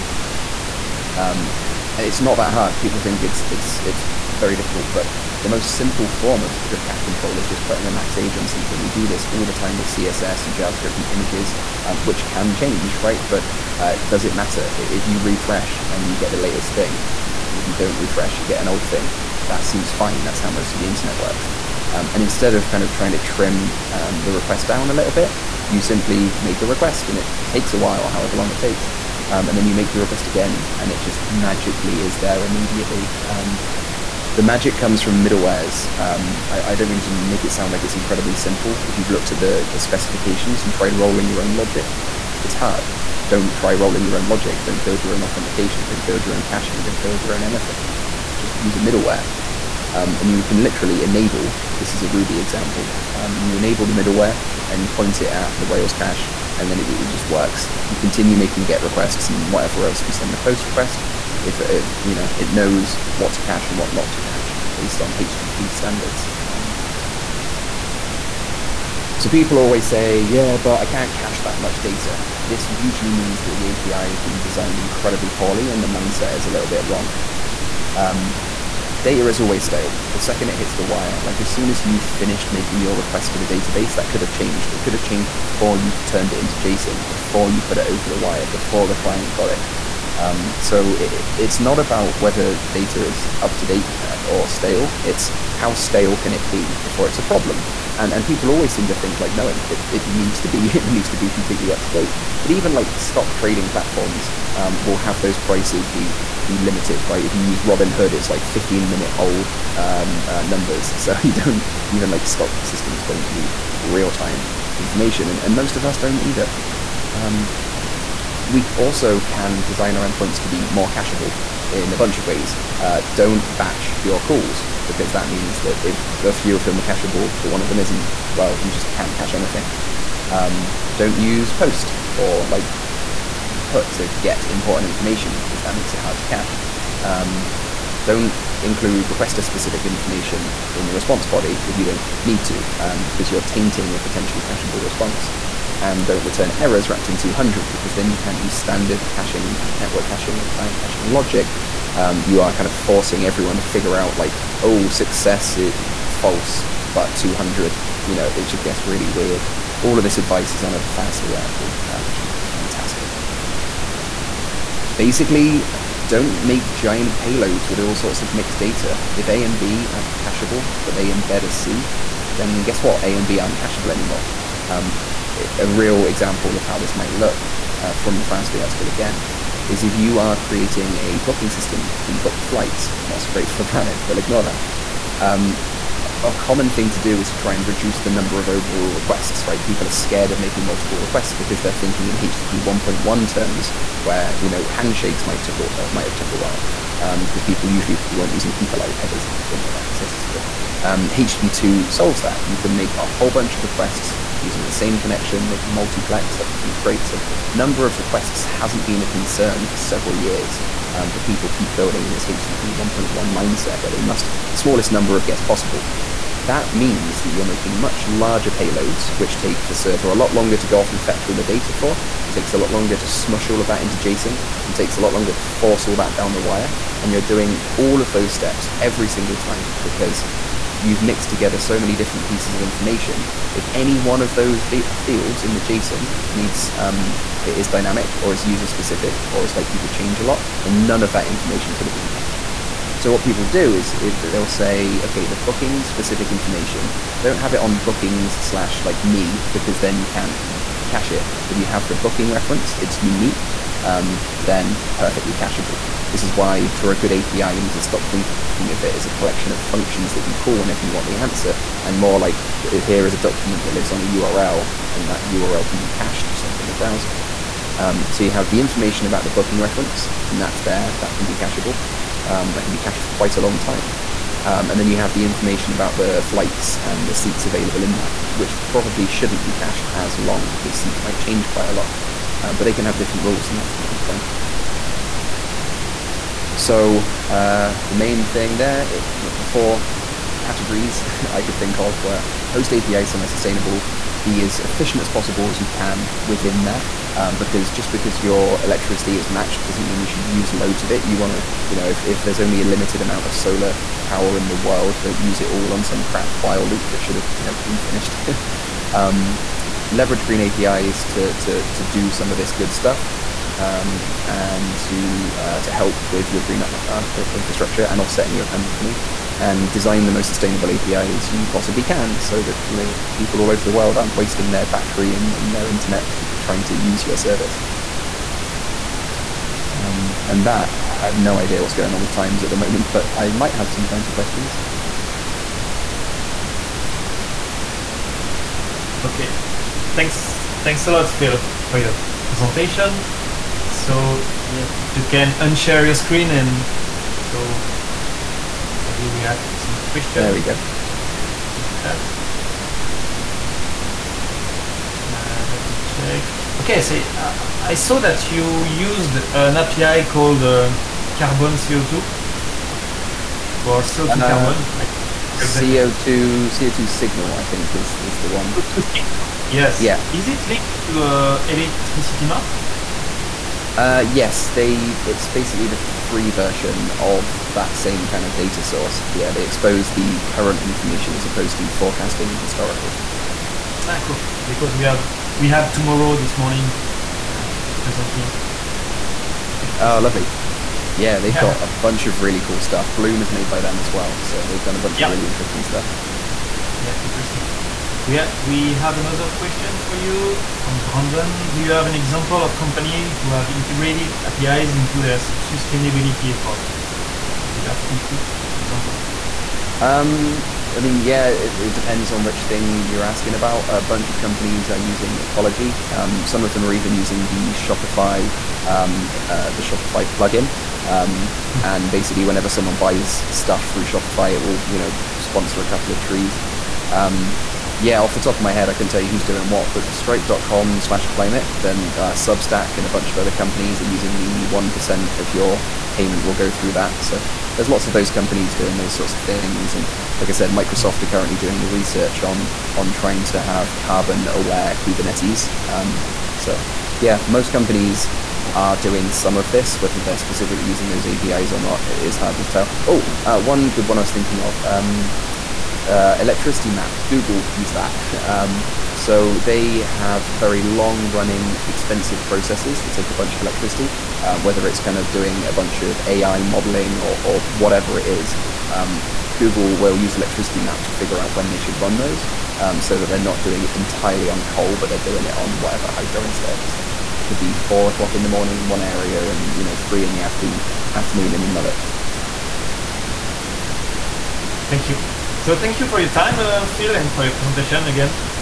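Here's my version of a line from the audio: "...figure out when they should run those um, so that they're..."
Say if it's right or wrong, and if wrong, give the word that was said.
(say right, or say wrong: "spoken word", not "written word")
right.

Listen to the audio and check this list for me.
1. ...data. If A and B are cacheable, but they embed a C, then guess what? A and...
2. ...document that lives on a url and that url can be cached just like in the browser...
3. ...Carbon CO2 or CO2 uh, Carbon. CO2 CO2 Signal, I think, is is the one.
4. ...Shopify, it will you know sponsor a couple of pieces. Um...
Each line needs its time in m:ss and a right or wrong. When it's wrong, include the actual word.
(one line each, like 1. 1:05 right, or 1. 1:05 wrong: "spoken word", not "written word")
1. 2:48 right
2. 4:23 right
3. 6:01 right
4. 7:03 wrong: "trees", not "pieces".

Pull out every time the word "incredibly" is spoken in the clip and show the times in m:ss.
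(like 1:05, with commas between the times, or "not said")
0:37, 1:14.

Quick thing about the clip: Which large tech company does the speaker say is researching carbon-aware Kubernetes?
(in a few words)
Microsoft.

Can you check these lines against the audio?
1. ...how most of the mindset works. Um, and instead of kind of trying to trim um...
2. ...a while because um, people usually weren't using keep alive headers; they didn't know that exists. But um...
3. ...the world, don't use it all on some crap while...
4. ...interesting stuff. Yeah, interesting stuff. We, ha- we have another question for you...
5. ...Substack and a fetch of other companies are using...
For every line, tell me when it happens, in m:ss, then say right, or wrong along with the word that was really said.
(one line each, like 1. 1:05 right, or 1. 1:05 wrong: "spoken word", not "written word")
1. 0:20 wrong: "internet", not "mindset"
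2. 3:16 right
3. 5:04 right
4. 6:35 right
5. 7:12 wrong: "bunch", not "fetch".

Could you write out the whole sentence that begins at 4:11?
If you have the booking reference, it's unique, um, then perfectly cacheable.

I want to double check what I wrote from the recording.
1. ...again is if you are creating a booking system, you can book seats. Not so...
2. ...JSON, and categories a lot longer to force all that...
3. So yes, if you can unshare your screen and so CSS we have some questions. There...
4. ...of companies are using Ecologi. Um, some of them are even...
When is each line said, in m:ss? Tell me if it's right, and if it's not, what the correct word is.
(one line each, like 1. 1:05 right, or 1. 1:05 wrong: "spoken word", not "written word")
1. 2:58 wrong: "flights", not "seats"
2. 3:43 wrong: "takes", not "categories"
3. 5:43 wrong: "Maybe", not "CSS"
4. 6:54 right.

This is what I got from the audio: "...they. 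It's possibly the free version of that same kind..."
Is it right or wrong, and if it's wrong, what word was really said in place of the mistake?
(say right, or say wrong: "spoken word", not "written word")
wrong: "basically", not "possibly".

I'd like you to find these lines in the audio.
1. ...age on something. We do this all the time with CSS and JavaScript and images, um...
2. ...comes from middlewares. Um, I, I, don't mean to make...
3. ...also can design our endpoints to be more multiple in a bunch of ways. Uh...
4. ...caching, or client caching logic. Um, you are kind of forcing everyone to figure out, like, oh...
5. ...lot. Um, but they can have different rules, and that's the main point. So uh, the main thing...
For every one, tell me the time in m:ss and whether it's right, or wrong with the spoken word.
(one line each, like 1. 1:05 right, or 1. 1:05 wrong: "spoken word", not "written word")
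1. 0:08 right
2. 0:34 right
3. 1:58 wrong: "cacheable", not "multiple"
4. 2:30 right
5. 4:41 right.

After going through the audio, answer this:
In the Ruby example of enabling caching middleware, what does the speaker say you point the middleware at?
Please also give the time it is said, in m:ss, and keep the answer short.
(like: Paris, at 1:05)
Rails cache, at 0:55.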